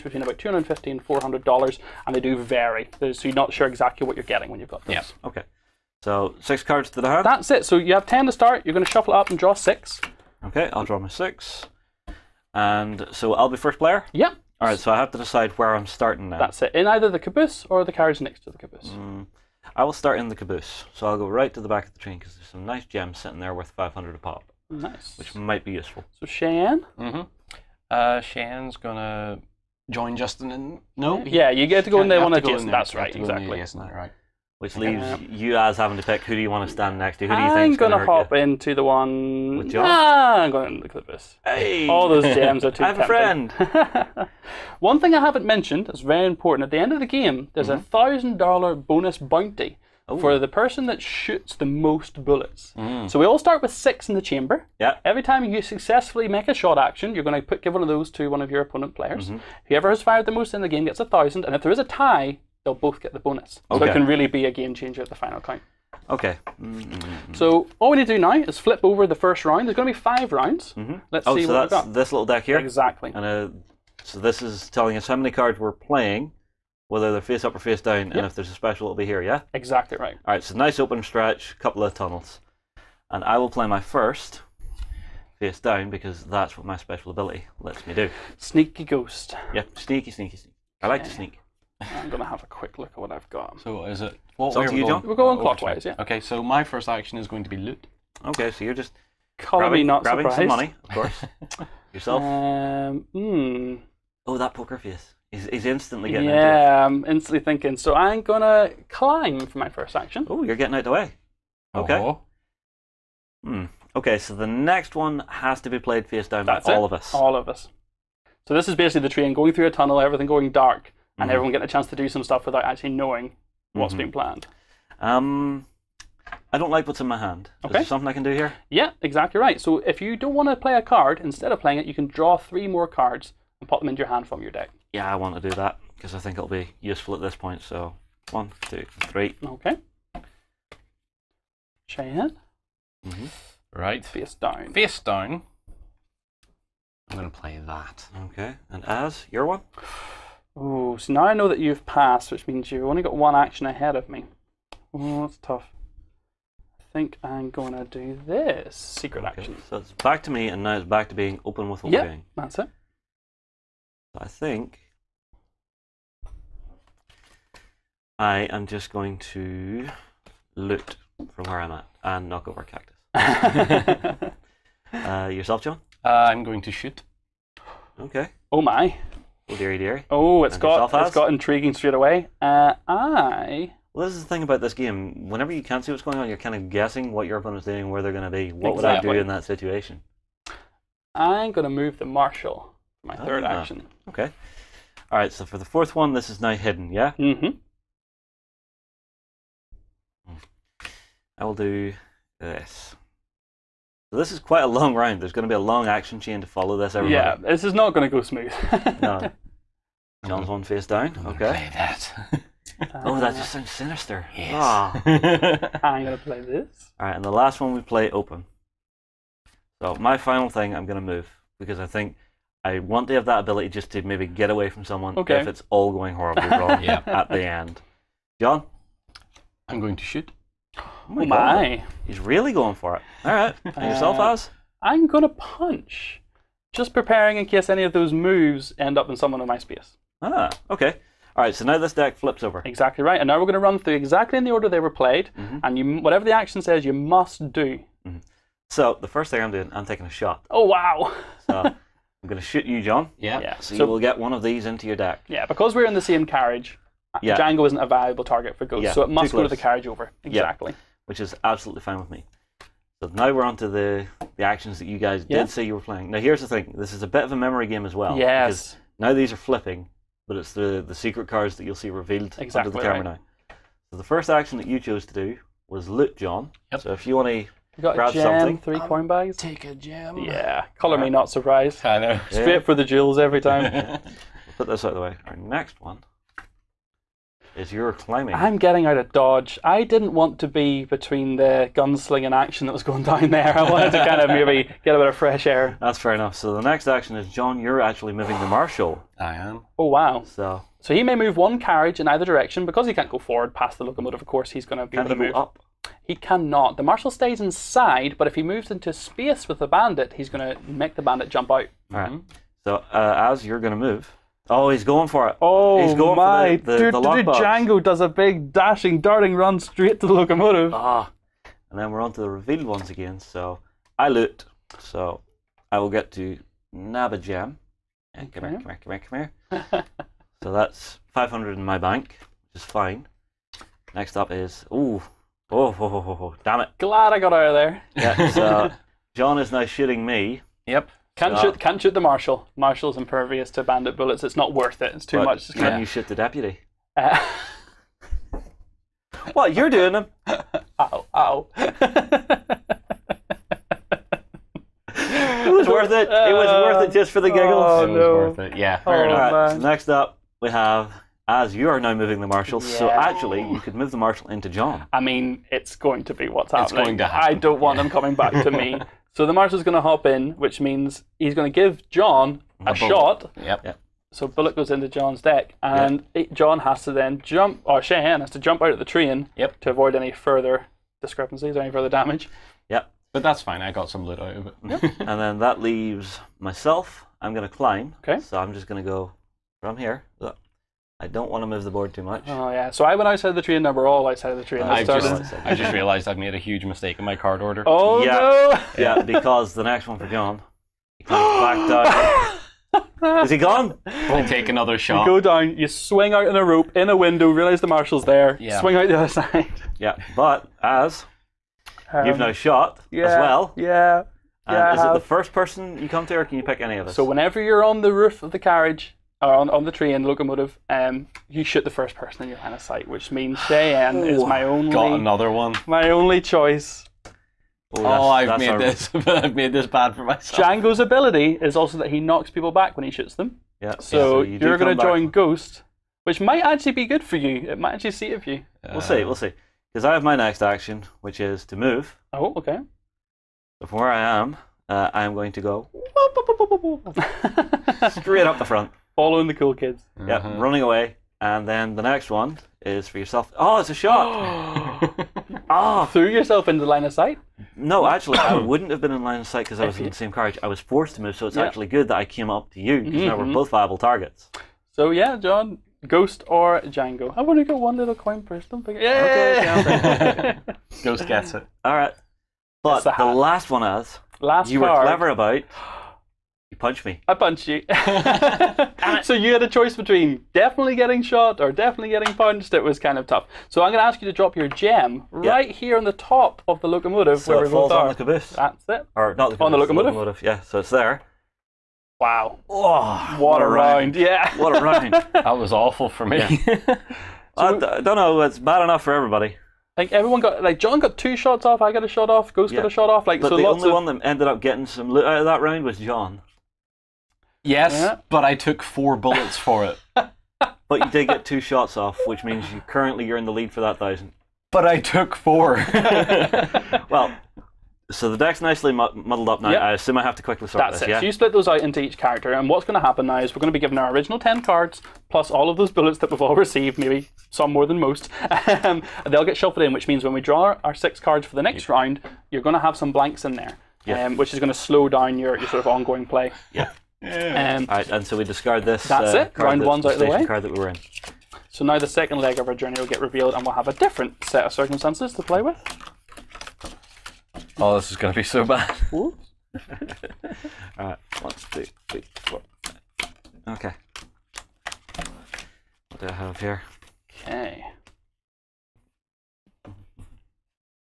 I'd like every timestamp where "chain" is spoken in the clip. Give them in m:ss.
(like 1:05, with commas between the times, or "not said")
2:21, 3:26.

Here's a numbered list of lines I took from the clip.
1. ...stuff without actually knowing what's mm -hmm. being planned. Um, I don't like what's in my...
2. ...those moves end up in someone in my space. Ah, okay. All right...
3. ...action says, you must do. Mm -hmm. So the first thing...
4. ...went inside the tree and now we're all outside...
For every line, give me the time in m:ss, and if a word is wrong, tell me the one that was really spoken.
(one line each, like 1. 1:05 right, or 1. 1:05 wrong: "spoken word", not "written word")
1. 2:02 right
2. 3:57 right
3. 4:06 right
4. 6:32 wrong: "outside", not "inside".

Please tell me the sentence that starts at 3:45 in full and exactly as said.
if it's all going horribly wrong yeah.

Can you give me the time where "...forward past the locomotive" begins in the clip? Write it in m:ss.
5:03.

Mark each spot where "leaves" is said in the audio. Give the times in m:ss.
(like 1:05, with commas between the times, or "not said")
0:34, 6:25.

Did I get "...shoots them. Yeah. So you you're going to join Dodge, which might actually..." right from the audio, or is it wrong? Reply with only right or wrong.
wrong.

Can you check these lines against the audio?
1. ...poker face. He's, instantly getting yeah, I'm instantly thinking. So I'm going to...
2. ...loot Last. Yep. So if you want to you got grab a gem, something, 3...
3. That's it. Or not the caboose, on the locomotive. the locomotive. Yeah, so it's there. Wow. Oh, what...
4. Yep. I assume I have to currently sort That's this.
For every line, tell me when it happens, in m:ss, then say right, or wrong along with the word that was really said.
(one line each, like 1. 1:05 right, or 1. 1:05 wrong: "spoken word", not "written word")
1. 1:44 right
2. 4:35 wrong: "John", not "Last"
3. 8:08 right
4. 8:39 wrong: "quickly", not "currently".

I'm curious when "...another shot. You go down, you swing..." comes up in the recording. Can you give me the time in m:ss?
6:44.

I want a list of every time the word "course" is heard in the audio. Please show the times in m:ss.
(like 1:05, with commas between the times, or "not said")
1:40, 5:04.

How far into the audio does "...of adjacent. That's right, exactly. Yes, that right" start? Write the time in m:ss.
0:32.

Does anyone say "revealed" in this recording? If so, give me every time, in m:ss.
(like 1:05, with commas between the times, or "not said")
4:31, 5:22, 9:03.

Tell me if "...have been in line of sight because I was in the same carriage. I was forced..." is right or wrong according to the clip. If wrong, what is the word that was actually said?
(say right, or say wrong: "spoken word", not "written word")
right.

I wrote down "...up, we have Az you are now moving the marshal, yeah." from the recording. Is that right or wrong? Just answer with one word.
right.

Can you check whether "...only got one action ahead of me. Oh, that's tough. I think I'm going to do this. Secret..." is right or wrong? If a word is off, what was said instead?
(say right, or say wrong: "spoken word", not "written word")
right.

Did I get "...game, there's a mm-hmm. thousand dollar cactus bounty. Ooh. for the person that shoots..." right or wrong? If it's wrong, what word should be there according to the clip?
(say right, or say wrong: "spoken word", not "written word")
wrong: "bonus", not "cactus".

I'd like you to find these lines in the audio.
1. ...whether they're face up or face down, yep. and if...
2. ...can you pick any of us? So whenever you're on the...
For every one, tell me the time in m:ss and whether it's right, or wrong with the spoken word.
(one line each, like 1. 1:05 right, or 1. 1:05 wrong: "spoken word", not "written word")
1. 1:16 right
2. 6:56 right.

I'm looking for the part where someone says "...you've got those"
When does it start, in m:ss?
0:04.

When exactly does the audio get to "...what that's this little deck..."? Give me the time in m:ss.
1:11.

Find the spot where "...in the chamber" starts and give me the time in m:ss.
0:54.